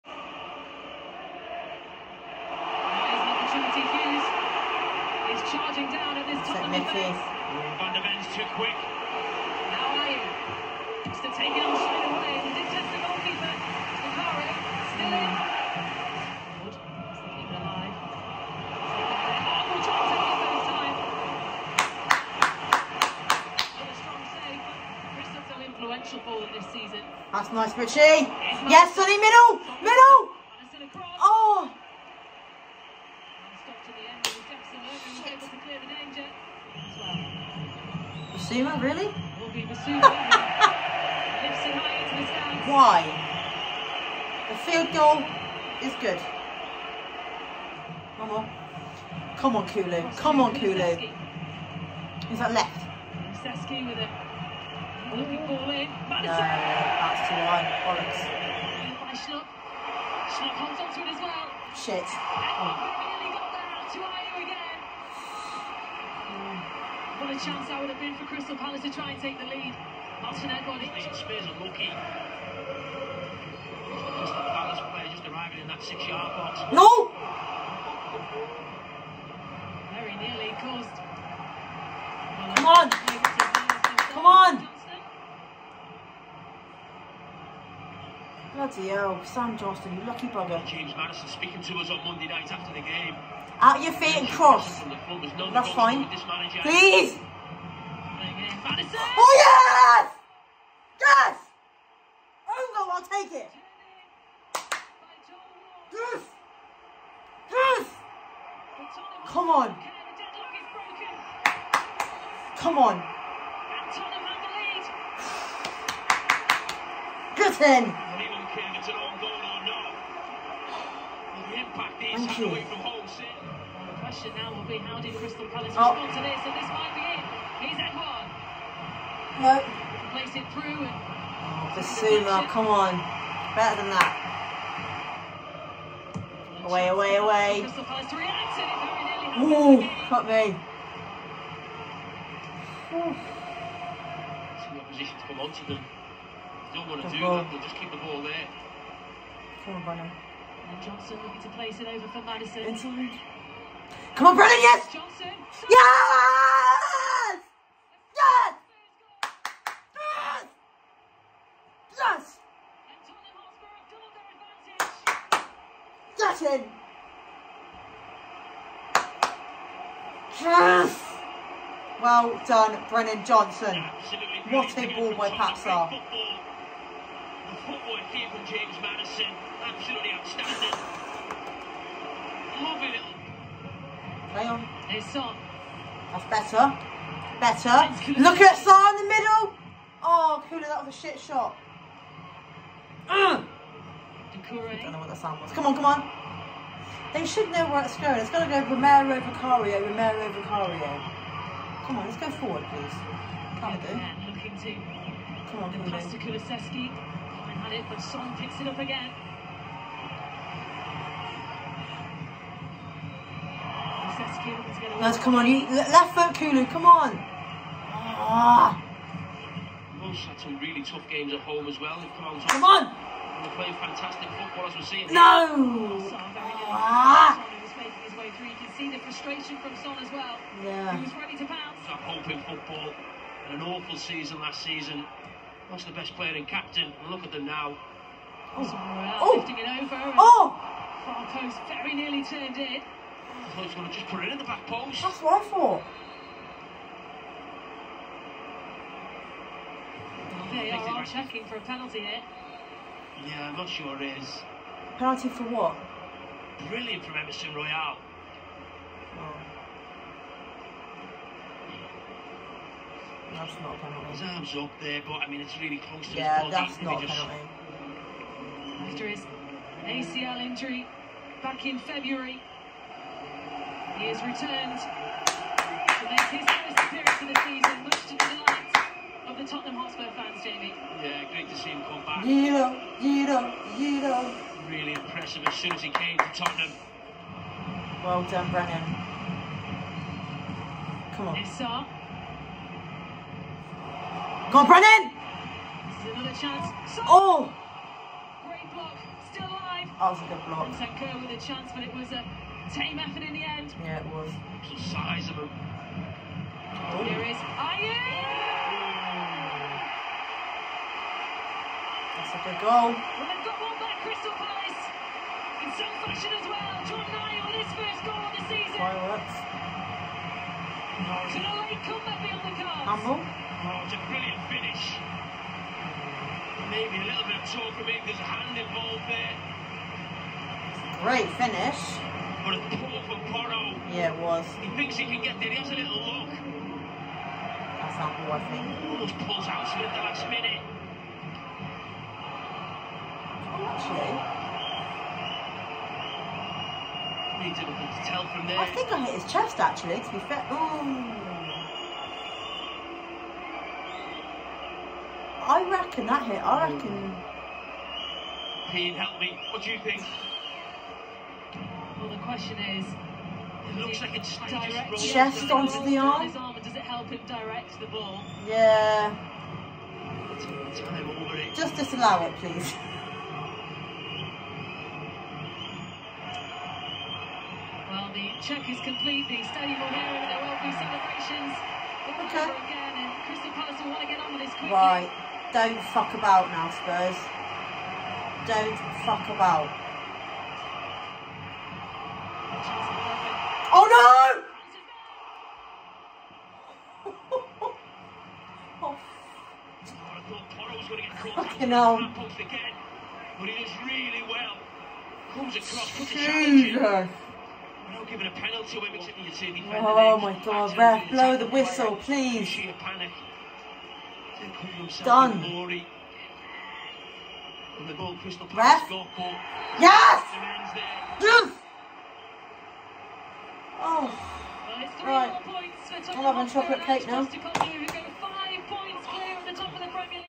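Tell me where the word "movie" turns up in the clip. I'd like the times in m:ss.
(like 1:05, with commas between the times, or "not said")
not said.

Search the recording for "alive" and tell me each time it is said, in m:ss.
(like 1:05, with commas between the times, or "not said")
0:17, 4:59.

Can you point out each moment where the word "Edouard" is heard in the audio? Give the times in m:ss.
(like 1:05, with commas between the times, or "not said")
2:07.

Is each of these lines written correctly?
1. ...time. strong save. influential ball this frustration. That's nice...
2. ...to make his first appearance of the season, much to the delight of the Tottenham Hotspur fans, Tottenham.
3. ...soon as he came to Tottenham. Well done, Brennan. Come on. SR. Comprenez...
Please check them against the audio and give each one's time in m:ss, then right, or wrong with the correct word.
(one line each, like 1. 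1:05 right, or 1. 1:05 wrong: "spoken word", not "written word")
1. 0:20 wrong: "season", not "frustration"
2. 4:34 wrong: "Jamie", not "Tottenham"
3. 4:45 right.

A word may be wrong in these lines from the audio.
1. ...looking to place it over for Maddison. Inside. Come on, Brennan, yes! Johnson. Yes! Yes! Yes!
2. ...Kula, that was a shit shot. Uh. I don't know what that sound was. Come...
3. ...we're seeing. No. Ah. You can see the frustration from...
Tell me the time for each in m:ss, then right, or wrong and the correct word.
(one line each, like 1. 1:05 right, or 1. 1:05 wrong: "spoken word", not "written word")
1. 2:31 right
2. 3:10 right
3. 3:44 right.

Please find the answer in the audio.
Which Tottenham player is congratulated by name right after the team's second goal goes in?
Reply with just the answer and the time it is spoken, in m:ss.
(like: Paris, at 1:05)
Brennan Johnson, at 2:52.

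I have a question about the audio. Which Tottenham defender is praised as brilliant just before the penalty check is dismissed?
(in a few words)
Emerson Royal.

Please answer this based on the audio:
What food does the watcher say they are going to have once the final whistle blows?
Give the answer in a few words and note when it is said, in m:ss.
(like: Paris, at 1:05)
chocolate cake, at 7:06.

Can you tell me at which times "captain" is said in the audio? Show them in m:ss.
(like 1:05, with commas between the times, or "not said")
3:56.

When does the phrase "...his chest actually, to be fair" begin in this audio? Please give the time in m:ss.
5:49.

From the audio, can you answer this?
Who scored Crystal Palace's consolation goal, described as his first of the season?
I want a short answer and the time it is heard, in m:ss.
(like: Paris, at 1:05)
John Ayew, at 5:16.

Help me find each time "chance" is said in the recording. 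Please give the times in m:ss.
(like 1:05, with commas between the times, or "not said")
1:07, 5:01.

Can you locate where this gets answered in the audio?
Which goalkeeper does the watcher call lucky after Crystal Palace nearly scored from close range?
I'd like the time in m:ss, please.
1:29.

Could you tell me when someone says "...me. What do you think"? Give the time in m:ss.
5:59.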